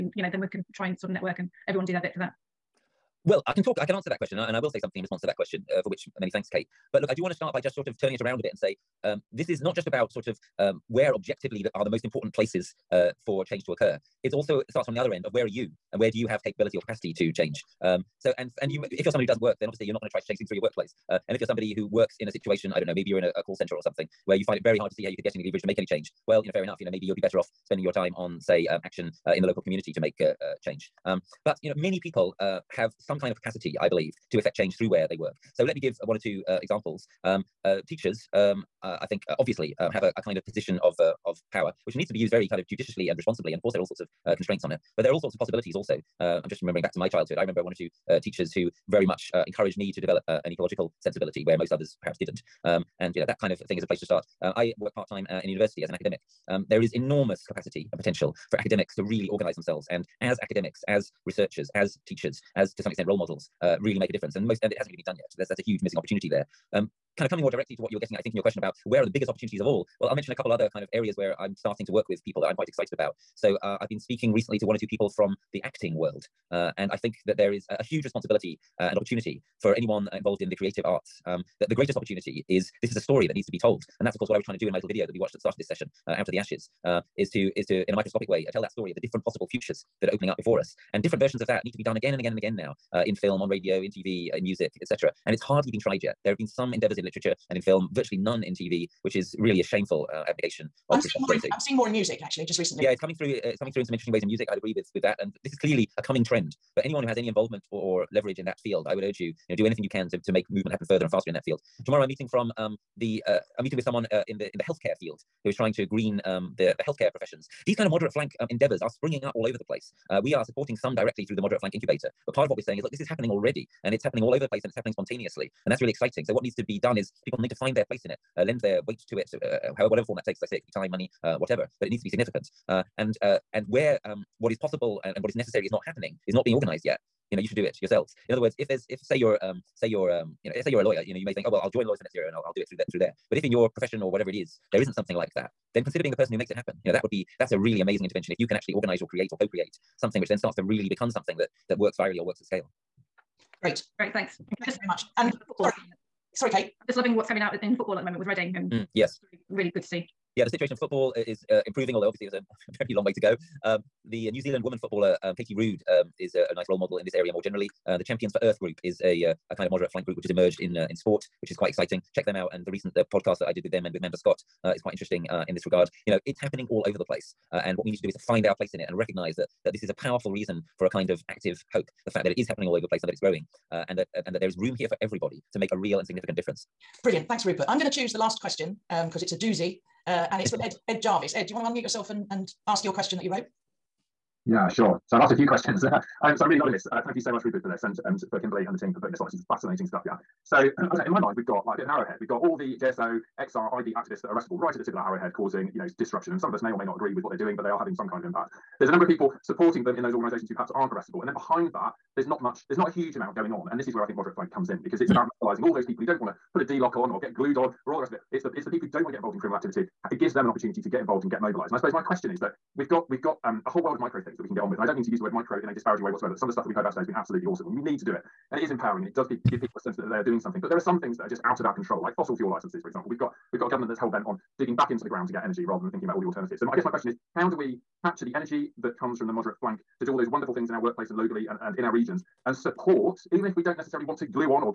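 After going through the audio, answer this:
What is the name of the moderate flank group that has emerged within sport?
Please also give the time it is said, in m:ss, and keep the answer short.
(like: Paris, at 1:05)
Champions for Earth, at 2:48.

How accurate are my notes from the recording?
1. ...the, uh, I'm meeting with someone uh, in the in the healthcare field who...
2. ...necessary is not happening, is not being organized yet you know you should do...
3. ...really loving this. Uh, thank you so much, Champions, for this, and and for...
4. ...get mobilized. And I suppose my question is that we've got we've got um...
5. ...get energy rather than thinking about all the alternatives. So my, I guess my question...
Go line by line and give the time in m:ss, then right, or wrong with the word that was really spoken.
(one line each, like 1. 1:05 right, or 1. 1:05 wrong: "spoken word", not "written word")
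1. 1:52 right
2. 2:15 right
3. 3:16 wrong: "Rupert", not "Champions"
4. 3:41 right
5. 3:55 right.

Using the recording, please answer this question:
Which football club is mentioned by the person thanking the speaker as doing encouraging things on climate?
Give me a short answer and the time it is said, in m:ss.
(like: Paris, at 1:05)
Reading, at 2:38.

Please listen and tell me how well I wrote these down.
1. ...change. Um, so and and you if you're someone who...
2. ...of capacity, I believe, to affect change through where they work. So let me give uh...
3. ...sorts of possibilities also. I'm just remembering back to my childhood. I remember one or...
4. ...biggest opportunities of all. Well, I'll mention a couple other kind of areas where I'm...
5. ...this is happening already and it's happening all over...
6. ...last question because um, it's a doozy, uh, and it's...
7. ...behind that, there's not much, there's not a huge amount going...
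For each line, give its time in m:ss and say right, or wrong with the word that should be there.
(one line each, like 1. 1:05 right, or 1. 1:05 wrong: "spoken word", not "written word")
1. 0:17 right
2. 0:33 right
3. 0:45 right
4. 1:09 right
5. 2:02 right
6. 3:08 right
7. 3:31 right.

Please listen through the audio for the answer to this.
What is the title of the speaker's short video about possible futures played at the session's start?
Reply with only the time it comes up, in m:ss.
1:26.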